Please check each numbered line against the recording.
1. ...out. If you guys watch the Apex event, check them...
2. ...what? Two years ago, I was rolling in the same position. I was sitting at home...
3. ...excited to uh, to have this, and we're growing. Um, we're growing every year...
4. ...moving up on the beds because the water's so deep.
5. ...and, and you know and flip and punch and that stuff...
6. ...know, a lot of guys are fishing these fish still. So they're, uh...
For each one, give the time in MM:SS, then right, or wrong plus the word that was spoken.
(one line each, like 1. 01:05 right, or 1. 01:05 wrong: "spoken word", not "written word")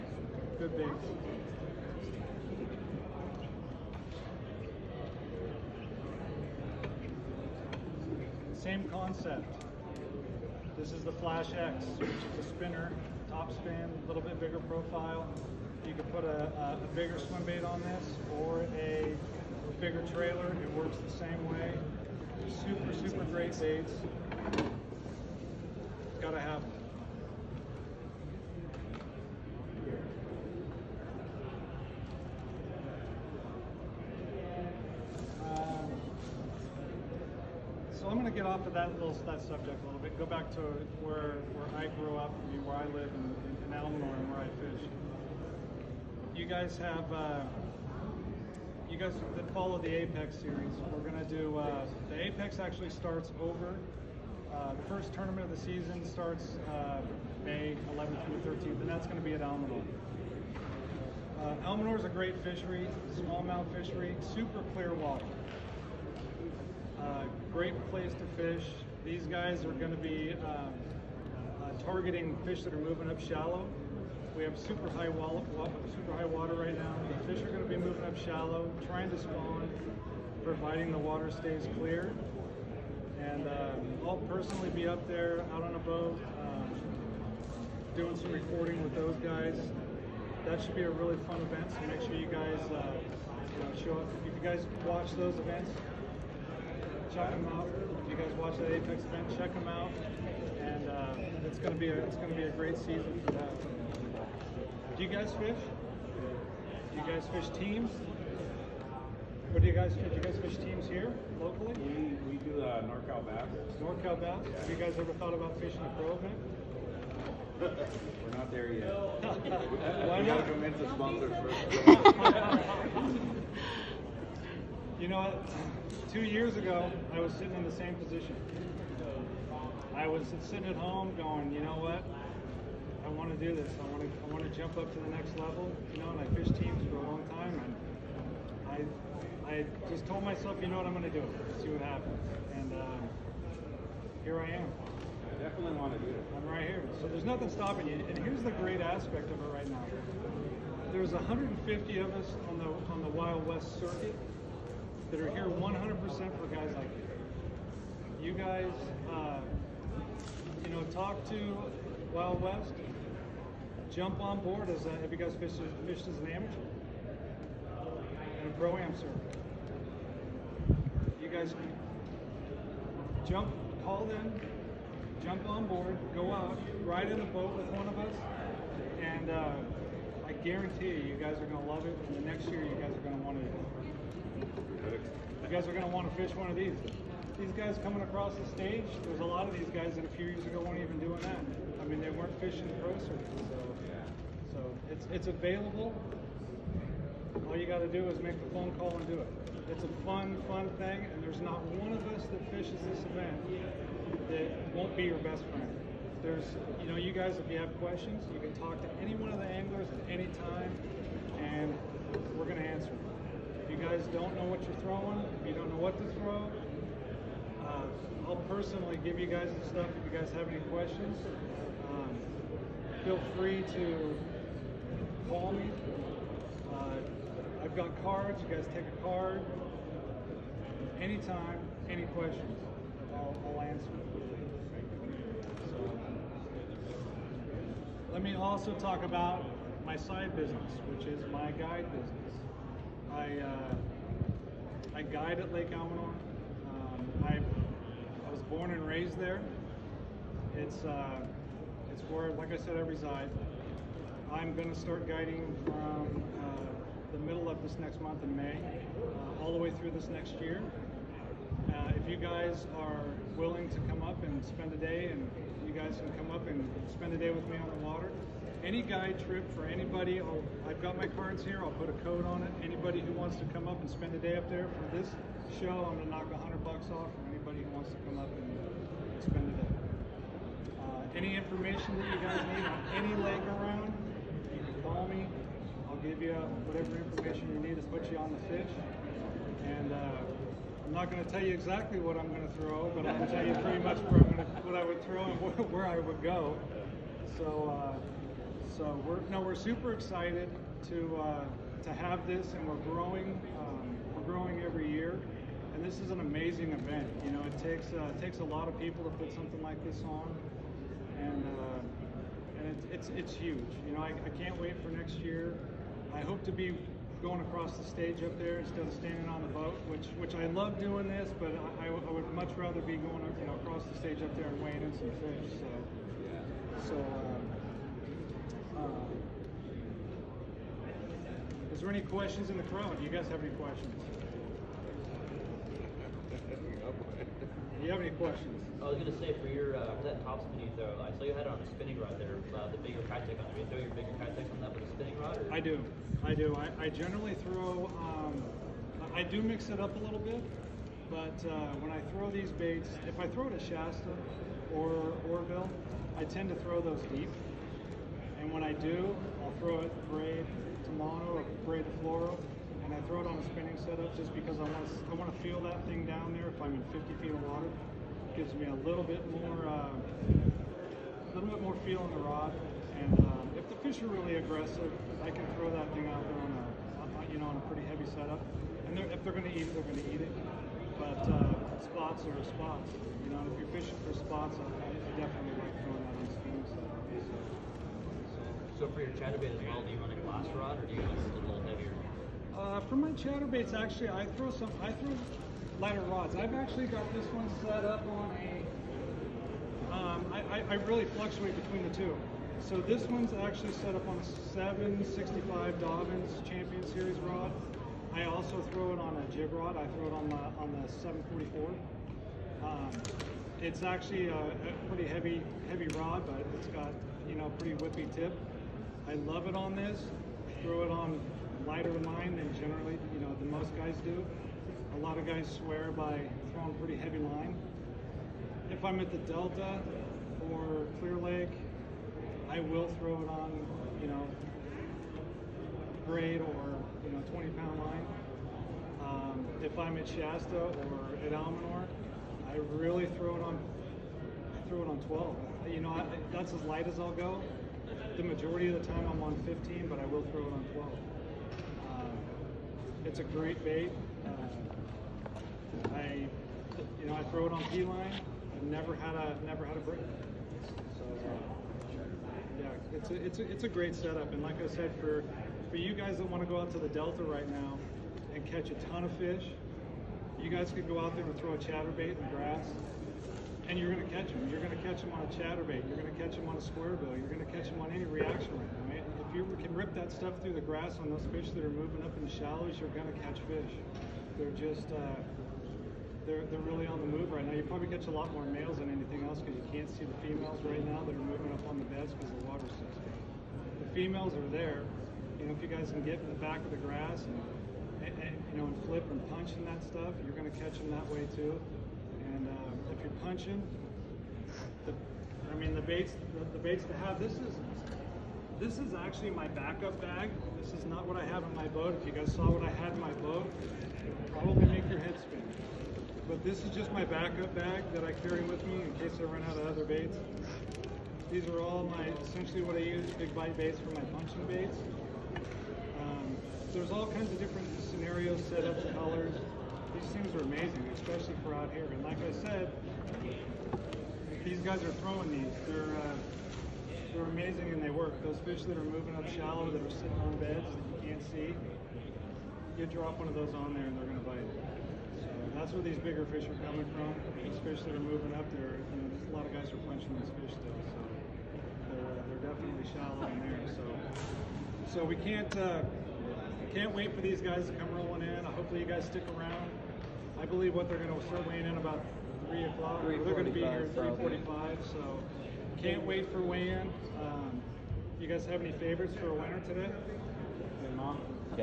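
1. 01:37 right
2. 02:05 wrong: "sitting", not "rolling"
3. 04:59 right
4. 08:11 right
5. 08:18 right
6. 09:09 wrong: "punching", not "fishing".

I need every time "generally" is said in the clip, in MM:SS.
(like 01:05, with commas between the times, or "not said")
05:46, 07:02.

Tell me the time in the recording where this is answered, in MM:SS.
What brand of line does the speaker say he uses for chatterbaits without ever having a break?
07:37.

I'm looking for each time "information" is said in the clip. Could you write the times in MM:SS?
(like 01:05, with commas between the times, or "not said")
04:41, 04:46.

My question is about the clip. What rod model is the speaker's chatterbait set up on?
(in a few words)
765 Dobyns Champion Series.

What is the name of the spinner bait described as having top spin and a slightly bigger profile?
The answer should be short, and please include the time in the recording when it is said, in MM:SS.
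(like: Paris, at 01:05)
Flash X, at 00:11.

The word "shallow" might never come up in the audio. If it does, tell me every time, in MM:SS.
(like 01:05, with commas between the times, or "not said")
01:13, 01:18, 08:02, 08:59, 09:12.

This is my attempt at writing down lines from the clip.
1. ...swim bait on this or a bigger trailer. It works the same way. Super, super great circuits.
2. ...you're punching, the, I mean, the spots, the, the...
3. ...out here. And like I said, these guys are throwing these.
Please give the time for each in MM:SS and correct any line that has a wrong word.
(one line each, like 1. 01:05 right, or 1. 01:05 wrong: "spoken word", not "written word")
1. 00:17 wrong: "baits", not "circuits"
2. 08:23 wrong: "baits", not "spots"
3. 08:51 right.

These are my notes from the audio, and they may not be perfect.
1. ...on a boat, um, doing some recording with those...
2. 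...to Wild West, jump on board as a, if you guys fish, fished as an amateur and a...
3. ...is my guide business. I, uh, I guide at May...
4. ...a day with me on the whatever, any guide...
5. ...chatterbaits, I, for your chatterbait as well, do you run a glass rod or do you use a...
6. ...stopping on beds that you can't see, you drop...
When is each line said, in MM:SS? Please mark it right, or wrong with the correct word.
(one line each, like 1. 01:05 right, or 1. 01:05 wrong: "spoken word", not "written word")
1. 01:25 right
2. 02:41 right
3. 04:01 wrong: "Lake", not "May"
4. 04:27 wrong: "water", not "whatever"
5. 06:24 wrong: "spots", not "chatterbaits"
6. 08:59 wrong: "sitting", not "stopping".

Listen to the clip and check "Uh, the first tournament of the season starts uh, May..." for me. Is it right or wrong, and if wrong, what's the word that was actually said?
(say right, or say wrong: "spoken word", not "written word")
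right.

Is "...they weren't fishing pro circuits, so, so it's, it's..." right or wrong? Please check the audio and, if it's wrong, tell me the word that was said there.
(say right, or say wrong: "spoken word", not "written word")
right.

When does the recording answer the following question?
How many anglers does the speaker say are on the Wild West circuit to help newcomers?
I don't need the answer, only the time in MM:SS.
02:31.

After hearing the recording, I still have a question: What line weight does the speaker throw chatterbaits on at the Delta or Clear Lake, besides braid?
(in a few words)
20 pound.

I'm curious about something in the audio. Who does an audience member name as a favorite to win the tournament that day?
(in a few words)
Ken Mah.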